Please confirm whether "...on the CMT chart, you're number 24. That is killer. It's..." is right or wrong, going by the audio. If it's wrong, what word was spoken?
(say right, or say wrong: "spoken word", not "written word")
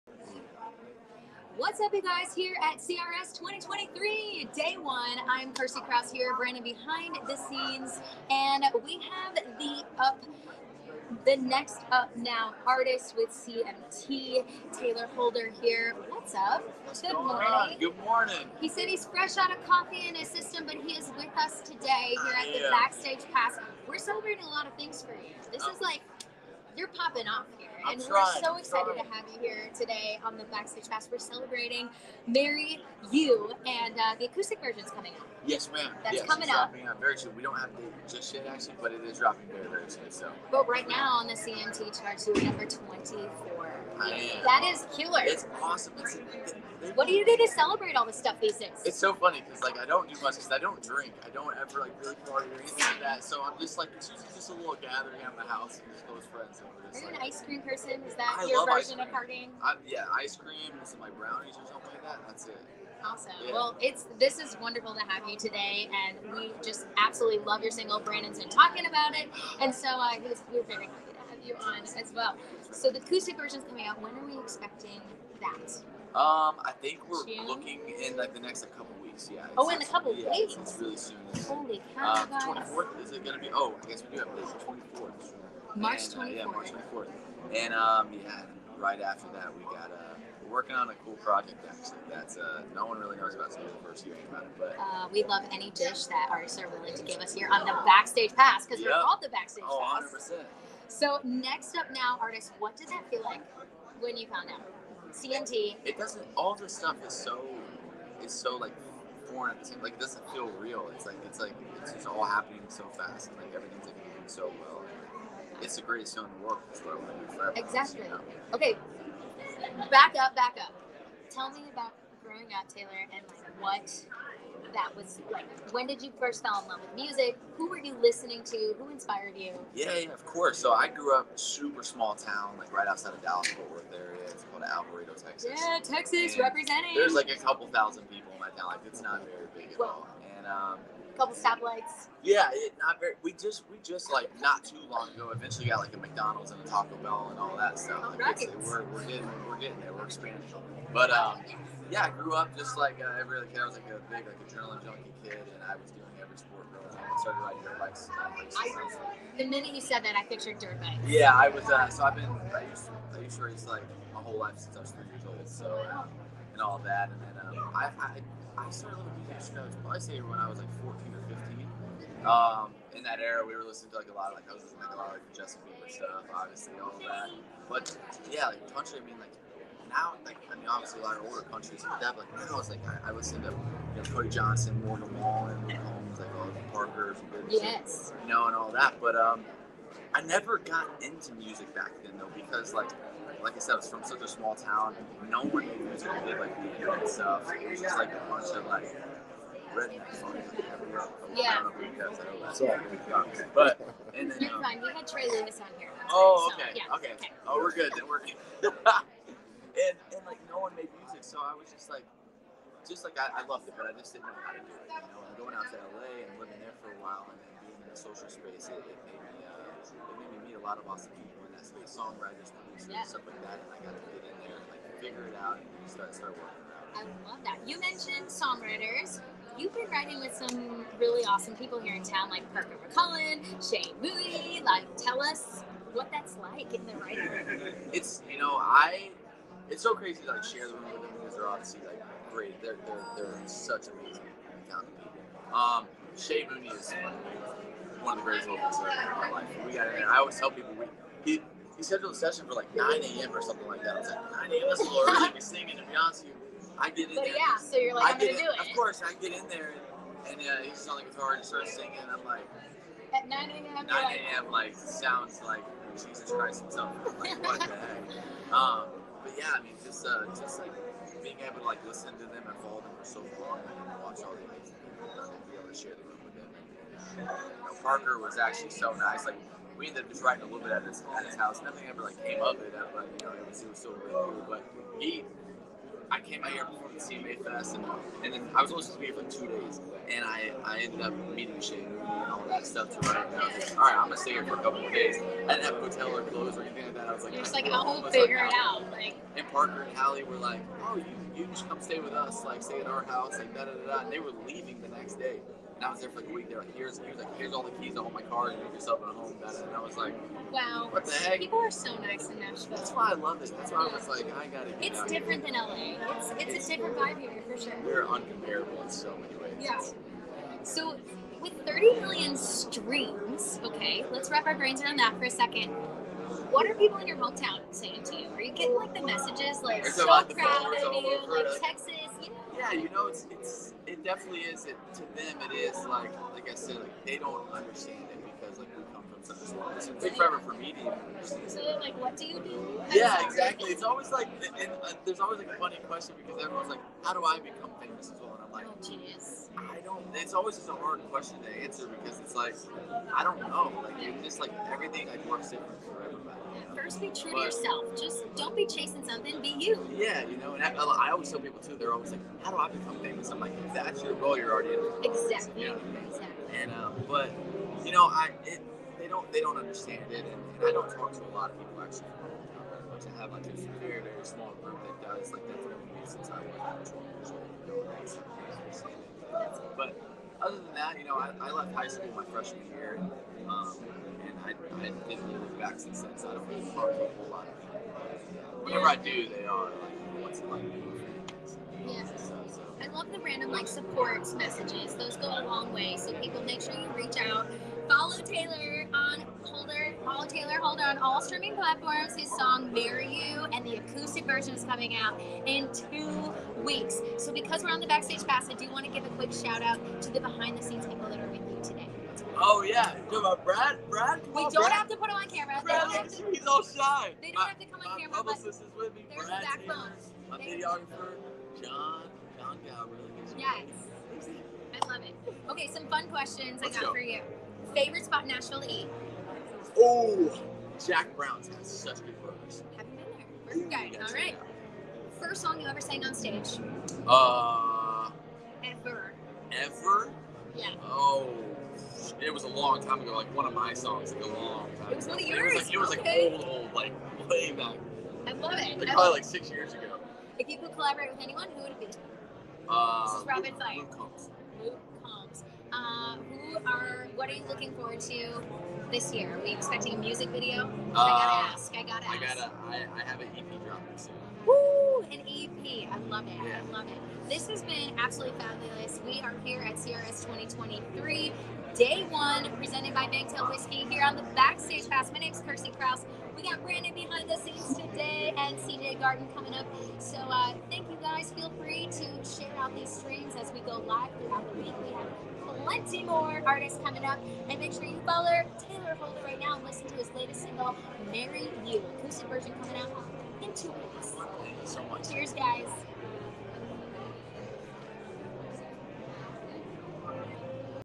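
right.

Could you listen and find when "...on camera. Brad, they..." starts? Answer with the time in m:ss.
6:55.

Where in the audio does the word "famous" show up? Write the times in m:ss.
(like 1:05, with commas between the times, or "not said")
5:47, 6:03.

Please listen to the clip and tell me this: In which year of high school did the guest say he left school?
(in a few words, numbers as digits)
Freshman year.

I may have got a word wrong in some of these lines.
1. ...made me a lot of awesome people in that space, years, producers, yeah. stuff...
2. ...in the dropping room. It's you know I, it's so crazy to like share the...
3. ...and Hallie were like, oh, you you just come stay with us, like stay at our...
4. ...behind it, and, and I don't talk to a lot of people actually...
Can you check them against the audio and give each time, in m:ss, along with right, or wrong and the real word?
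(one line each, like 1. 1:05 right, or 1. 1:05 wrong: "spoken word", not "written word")
1. 3:39 wrong: "songwriters", not "years"
2. 3:56 wrong: "writing", not "dropping"
3. 4:59 right
4. 6:09 wrong: "understand", not "behind".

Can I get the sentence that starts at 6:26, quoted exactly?
So I don't really talk to a whole lot of people.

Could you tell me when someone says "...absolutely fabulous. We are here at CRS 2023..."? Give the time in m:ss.
7:47.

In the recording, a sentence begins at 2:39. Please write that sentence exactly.
the minute you said that, I pictured dirt bikes.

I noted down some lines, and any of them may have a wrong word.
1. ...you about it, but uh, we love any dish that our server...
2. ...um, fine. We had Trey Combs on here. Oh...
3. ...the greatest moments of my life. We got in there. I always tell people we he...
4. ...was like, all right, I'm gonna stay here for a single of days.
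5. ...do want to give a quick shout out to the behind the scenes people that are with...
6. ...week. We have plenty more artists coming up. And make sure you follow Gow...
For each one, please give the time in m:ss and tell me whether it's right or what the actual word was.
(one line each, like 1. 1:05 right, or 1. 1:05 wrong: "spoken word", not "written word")
1. 1:34 right
2. 3:24 wrong: "Lewis", not "Combs"
3. 4:08 right
4. 4:53 wrong: "couple", not "single"
5. 6:48 right
6. 8:04 wrong: "Tayler", not "Gow".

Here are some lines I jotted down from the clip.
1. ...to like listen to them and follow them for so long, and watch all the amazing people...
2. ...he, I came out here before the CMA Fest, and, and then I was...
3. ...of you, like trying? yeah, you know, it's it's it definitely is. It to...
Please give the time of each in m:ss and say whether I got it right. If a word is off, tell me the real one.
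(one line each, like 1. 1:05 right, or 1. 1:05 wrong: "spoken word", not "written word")
1. 4:31 right
2. 4:44 right
3. 5:30 wrong: "texting", not "trying".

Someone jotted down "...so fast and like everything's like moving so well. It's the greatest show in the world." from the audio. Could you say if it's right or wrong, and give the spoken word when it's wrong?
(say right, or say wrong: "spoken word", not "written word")
right.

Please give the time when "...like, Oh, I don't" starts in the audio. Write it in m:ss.
5:48.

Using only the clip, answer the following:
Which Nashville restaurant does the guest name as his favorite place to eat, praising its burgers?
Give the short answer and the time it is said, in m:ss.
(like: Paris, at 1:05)
Jack Brown's, at 7:10.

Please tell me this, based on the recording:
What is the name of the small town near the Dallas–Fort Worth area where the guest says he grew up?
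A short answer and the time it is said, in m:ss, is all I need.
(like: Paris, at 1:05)
Alvarado, Texas, at 2:14.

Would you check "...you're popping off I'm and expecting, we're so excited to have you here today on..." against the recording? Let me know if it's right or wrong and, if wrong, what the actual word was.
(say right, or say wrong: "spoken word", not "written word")
wrong: "trying", not "expecting".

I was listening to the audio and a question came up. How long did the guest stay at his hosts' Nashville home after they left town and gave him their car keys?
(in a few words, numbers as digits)
A week.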